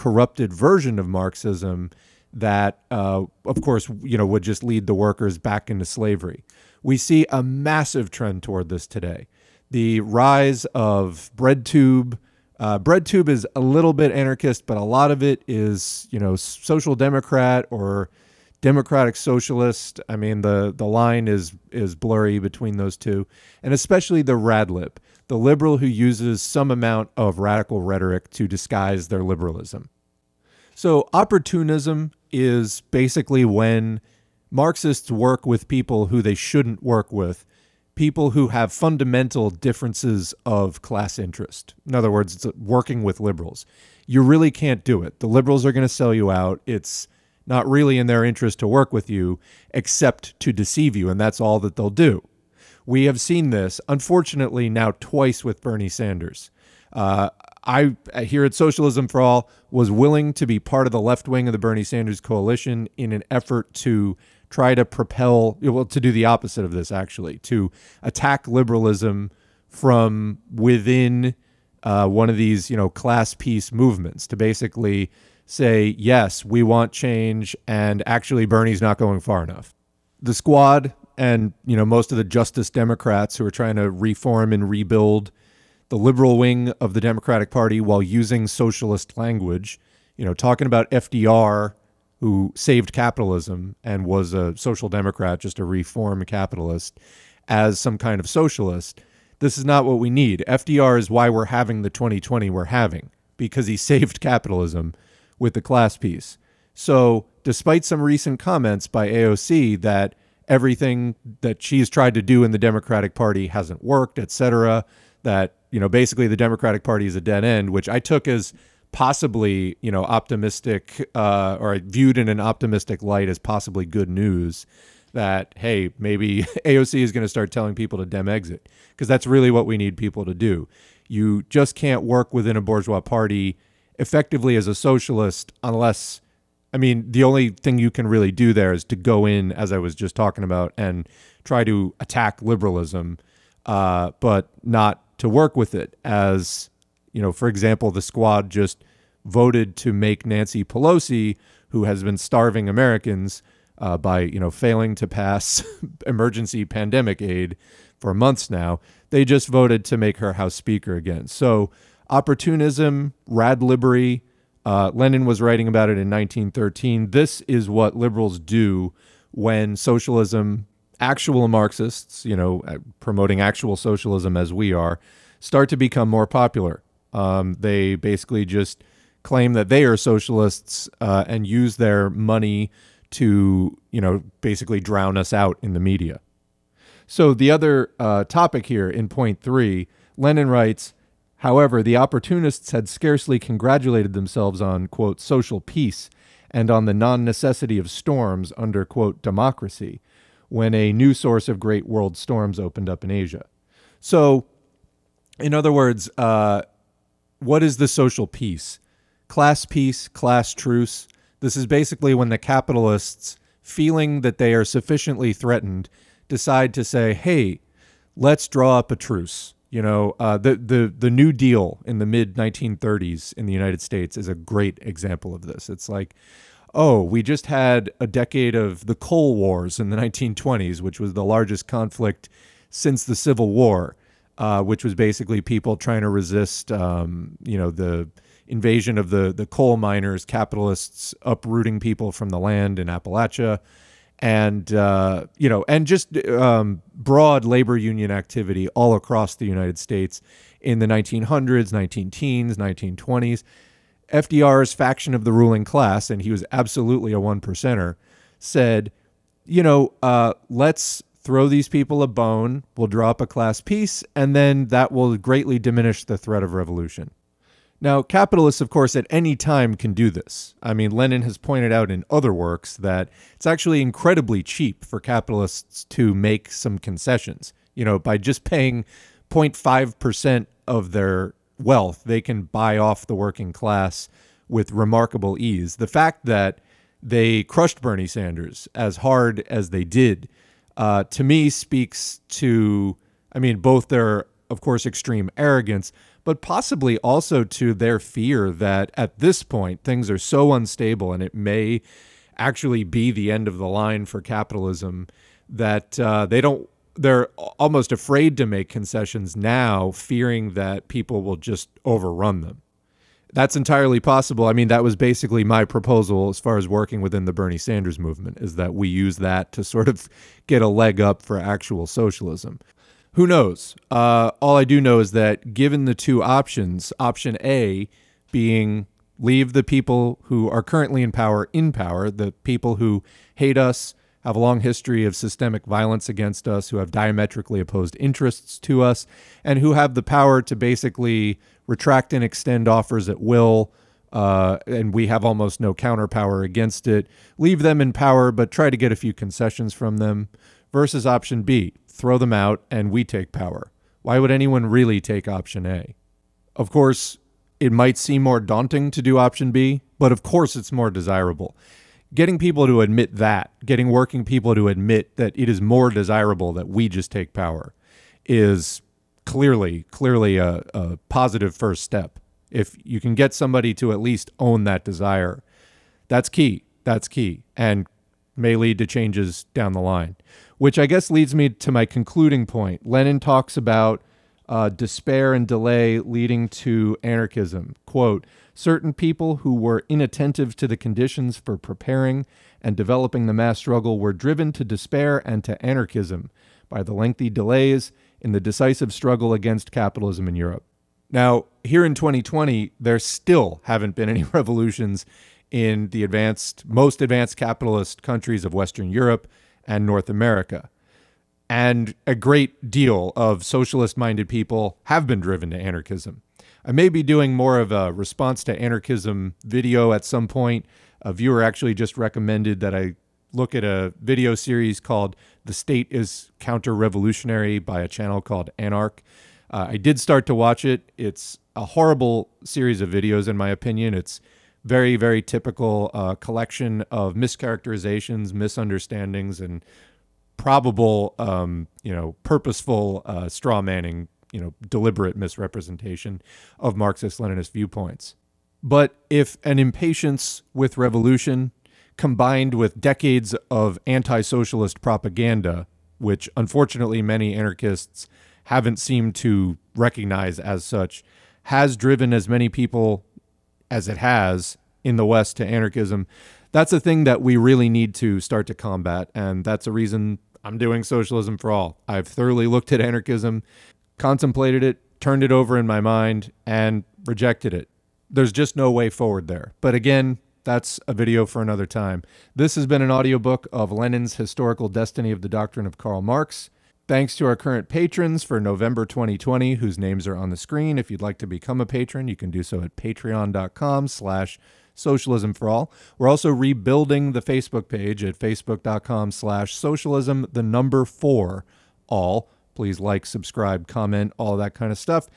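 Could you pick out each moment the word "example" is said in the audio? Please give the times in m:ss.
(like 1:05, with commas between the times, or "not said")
2:27, 3:44.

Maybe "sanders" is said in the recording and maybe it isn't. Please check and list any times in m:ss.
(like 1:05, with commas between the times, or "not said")
0:55, 1:01, 4:48, 5:17.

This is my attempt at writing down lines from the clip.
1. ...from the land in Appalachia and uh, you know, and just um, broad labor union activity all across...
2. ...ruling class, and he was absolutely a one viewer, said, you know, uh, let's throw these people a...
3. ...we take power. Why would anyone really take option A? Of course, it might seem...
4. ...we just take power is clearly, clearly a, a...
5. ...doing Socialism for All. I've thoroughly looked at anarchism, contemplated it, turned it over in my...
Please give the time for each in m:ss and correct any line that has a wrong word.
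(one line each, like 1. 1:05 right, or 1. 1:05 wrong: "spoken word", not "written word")
1. 4:02 right
2. 4:15 wrong: "percenter", not "viewer"
3. 5:52 right
4. 6:06 right
5. 7:50 right.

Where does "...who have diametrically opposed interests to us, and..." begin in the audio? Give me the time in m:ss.
5:36.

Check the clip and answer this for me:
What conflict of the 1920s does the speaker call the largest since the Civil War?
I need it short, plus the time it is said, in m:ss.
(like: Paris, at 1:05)
The Coal Wars, at 3:48.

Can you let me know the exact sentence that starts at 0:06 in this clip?
We see a massive trend toward this today.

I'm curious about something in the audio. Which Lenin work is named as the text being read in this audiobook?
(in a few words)
Historical Destiny of the Doctrine of Karl Marx.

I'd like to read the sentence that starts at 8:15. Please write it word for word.
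We're also rebuilding the Facebook page at facebook.com slash socialism, the number four, all.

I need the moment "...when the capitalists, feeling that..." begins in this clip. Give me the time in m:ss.
3:32.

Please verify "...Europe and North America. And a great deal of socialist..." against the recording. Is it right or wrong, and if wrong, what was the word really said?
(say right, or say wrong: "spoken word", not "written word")
right.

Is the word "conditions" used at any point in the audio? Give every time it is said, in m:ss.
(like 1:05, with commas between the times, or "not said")
6:30.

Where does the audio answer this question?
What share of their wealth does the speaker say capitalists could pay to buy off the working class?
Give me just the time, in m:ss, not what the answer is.
4:39.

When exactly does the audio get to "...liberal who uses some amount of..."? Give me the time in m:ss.
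0:25.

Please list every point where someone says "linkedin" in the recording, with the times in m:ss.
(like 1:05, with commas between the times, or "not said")
not said.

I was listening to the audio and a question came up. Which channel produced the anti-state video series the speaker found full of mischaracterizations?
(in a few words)
Anark.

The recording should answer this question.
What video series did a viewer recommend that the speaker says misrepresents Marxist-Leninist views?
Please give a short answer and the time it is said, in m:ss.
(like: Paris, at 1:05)
The State is Counter Revolutionary, at 7:05.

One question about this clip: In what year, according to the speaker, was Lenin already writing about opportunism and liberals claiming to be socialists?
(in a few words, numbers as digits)
1913.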